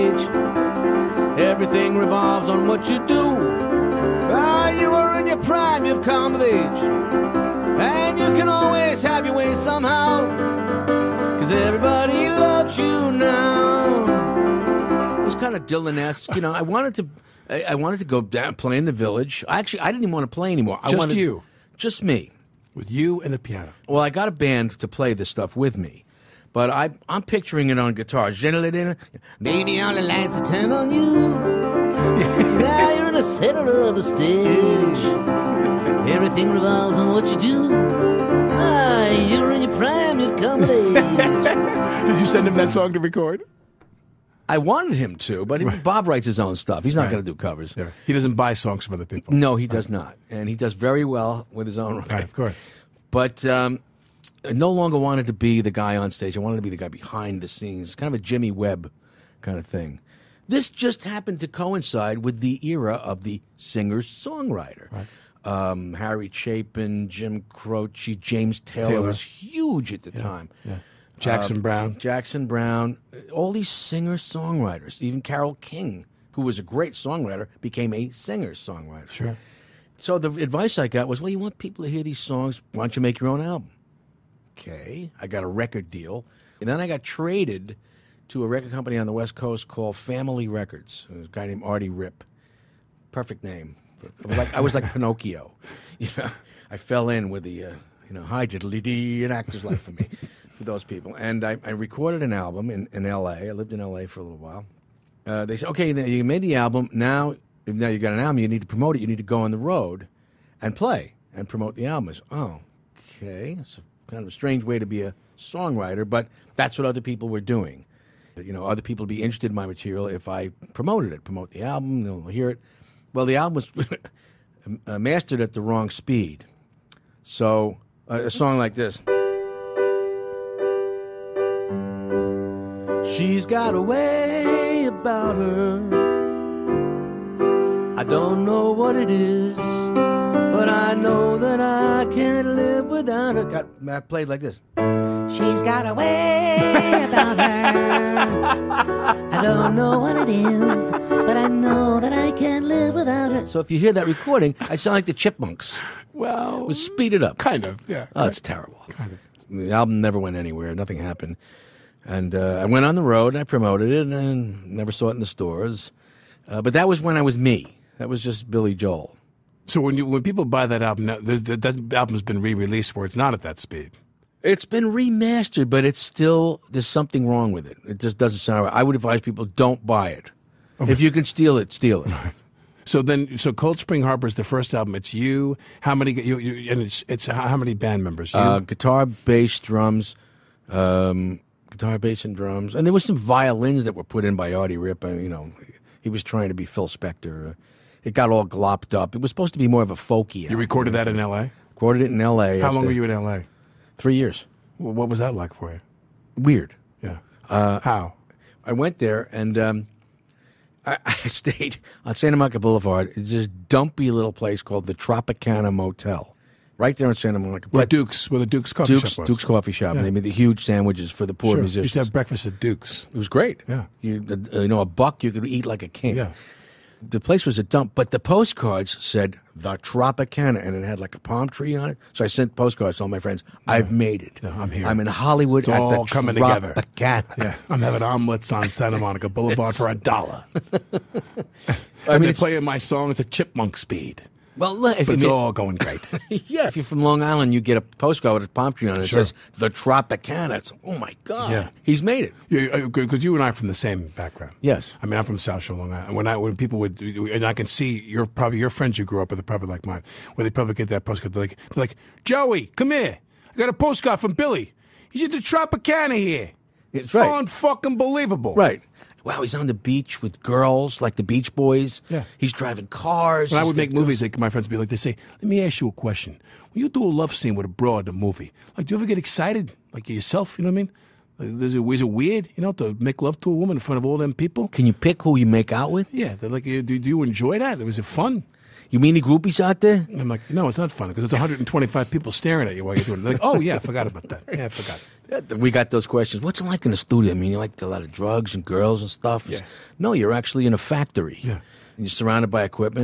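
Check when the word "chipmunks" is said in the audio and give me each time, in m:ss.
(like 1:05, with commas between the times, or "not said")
2:35, 4:03.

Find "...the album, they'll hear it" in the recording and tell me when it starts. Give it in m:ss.
2:01.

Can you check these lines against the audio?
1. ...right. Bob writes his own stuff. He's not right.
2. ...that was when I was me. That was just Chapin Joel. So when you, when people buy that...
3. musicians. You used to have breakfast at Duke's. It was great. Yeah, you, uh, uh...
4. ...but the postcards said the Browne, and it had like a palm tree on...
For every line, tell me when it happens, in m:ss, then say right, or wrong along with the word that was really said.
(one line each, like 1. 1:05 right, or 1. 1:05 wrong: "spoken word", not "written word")
1. 0:45 right
2. 2:46 wrong: "Billy", not "Chapin"
3. 3:41 right
4. 3:47 wrong: "Tropicana", not "Browne".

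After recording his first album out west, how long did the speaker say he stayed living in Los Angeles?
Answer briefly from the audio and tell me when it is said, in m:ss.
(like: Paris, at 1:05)
3 years, at 3:23.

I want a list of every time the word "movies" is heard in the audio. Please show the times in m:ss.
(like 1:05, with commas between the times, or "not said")
4:33, 4:38.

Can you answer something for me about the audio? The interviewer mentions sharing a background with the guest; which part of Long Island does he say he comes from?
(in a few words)
South Shore.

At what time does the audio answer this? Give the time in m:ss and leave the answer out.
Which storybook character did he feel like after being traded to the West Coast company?
1:34.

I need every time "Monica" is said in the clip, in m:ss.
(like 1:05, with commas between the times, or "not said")
3:32, 3:37, 3:58.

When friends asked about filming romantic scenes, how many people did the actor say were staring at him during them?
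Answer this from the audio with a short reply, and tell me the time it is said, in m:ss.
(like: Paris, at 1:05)
125, at 4:51.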